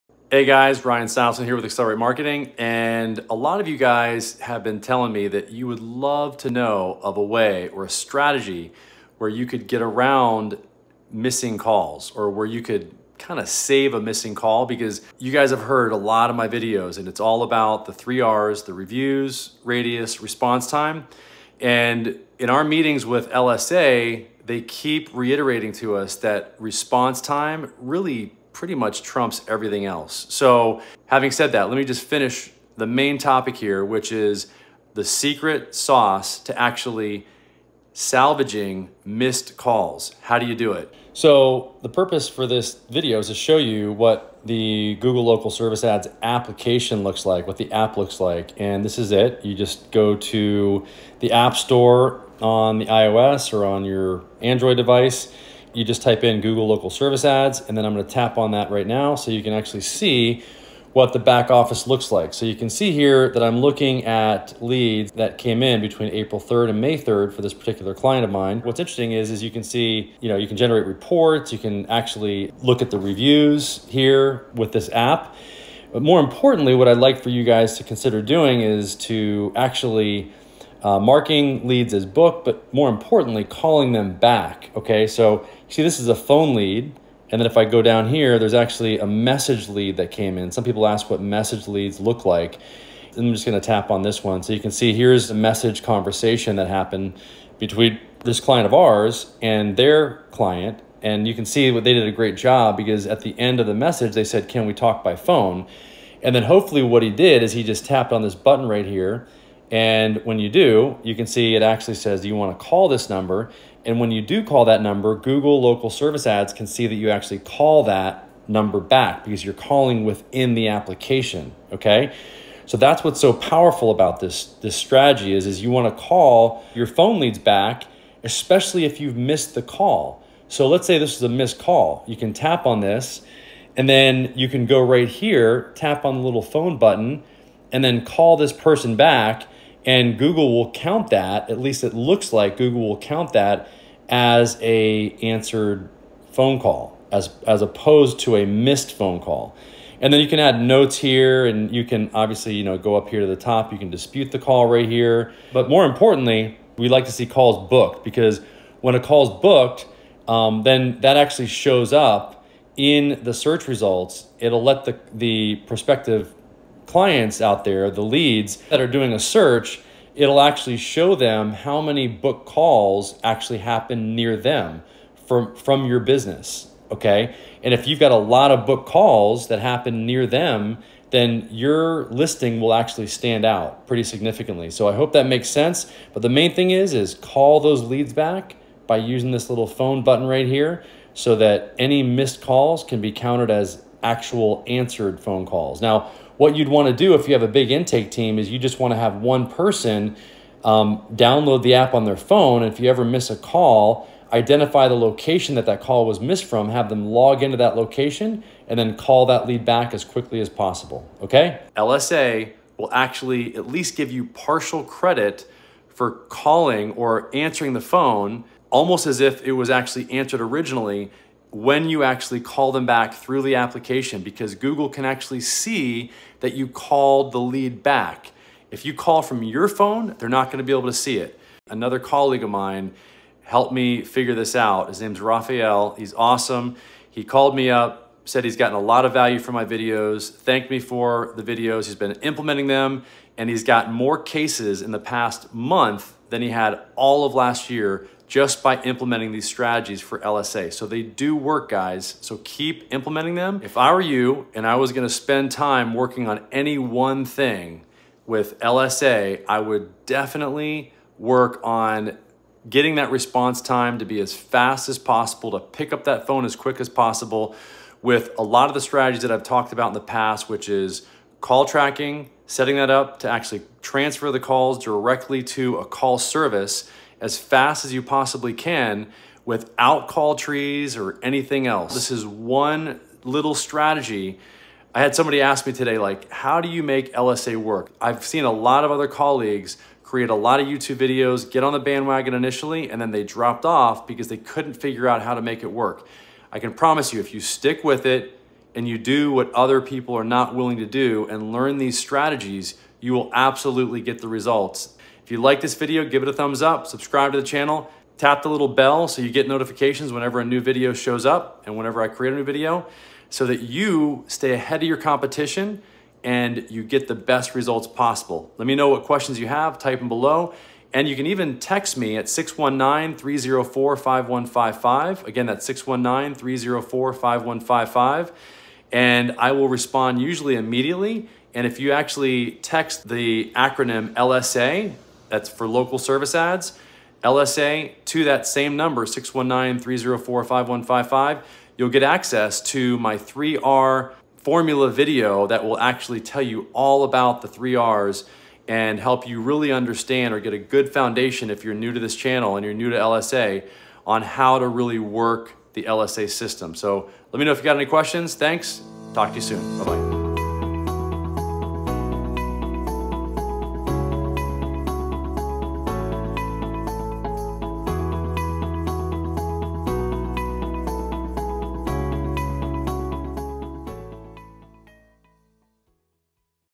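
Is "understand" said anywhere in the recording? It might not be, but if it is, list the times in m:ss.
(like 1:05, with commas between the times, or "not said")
5:49.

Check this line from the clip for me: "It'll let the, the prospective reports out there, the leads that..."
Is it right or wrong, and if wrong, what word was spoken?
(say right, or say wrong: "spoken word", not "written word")
wrong: "clients", not "reports".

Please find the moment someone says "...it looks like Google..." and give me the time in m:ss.
2:21.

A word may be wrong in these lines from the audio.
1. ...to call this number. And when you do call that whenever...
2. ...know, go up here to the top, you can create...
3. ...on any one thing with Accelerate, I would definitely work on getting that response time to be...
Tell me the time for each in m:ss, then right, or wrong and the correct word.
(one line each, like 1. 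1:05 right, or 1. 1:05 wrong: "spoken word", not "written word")
1. 1:52 wrong: "number", not "whenever"
2. 2:32 wrong: "dispute", not "create"
3. 4:16 wrong: "LSA", not "Accelerate".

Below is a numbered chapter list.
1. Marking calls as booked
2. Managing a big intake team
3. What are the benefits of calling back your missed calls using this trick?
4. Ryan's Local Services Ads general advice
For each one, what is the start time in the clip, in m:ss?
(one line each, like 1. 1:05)
1. 2:33
2. 3:16
3. 3:32
4. 4:14.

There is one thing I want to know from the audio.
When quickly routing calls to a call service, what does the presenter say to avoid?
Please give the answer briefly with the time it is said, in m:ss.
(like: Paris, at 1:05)
Call trees, at 4:40.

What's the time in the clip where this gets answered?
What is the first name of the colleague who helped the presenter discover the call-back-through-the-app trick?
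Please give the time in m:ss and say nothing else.
3:55.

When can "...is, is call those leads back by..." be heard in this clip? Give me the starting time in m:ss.
3:06.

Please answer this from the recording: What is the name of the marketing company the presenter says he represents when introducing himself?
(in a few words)
Accelerate Marketing.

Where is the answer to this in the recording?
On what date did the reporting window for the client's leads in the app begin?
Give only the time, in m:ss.
1:06.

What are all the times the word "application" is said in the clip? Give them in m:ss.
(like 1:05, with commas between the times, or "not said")
0:46, 2:00, 3:43.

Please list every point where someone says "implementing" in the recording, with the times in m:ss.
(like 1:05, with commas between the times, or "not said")
4:02, 4:08, 4:12.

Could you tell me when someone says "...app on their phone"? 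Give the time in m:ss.
3:21.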